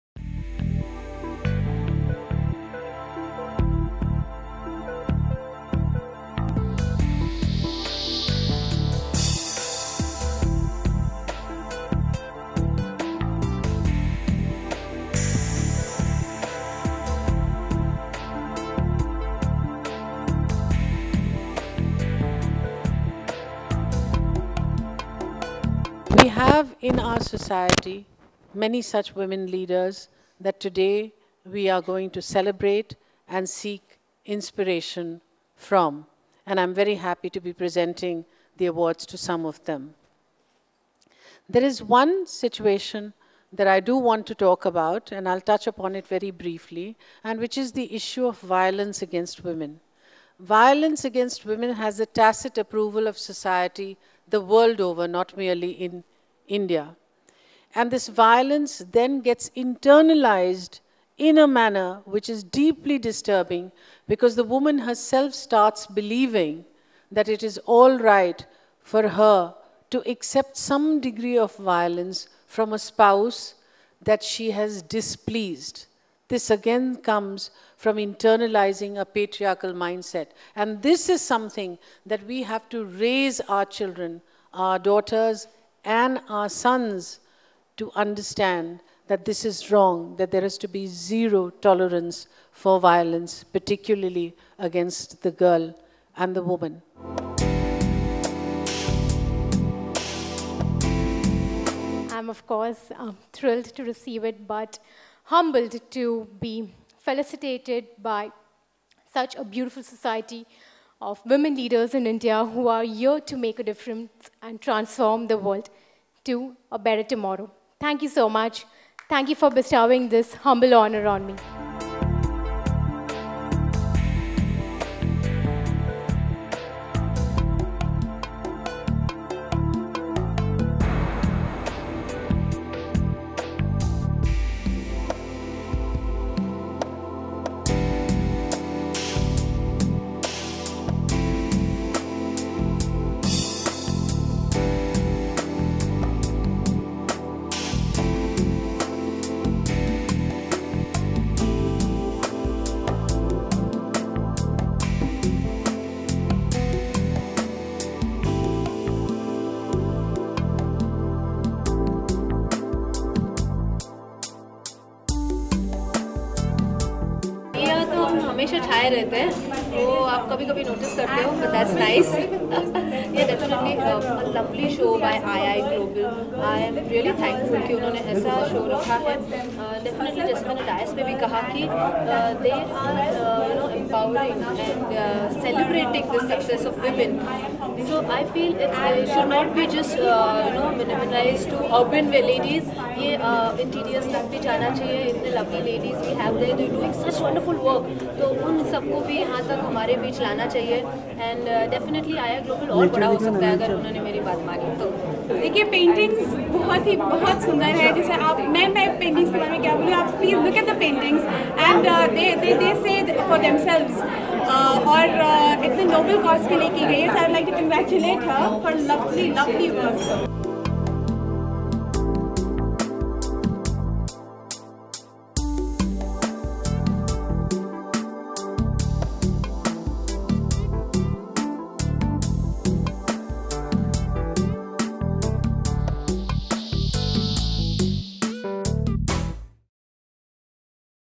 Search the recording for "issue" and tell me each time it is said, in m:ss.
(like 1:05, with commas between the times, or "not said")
0:47.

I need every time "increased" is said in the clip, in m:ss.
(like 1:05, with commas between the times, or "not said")
not said.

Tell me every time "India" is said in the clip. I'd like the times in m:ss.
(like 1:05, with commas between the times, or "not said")
0:56, 1:52.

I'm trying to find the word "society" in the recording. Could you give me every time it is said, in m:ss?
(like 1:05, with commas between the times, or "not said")
0:27, 0:53, 1:49.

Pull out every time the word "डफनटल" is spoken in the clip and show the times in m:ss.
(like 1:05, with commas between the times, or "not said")
2:53, 2:59, 3:21.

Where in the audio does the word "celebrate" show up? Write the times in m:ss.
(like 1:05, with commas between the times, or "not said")
0:32.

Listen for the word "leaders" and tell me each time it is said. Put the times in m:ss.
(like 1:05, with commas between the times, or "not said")
0:29, 1:51.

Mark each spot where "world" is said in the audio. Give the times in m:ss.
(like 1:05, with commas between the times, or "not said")
0:54, 1:55.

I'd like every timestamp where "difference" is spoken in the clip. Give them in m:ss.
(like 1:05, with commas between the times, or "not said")
1:53.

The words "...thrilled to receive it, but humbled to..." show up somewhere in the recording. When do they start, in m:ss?
1:43.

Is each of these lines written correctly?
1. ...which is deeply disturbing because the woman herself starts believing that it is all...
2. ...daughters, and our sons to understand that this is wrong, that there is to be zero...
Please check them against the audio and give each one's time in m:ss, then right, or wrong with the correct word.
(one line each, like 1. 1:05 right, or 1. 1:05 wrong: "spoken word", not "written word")
1. 1:02 right
2. 1:24 right.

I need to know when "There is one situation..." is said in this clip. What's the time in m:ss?
0:41.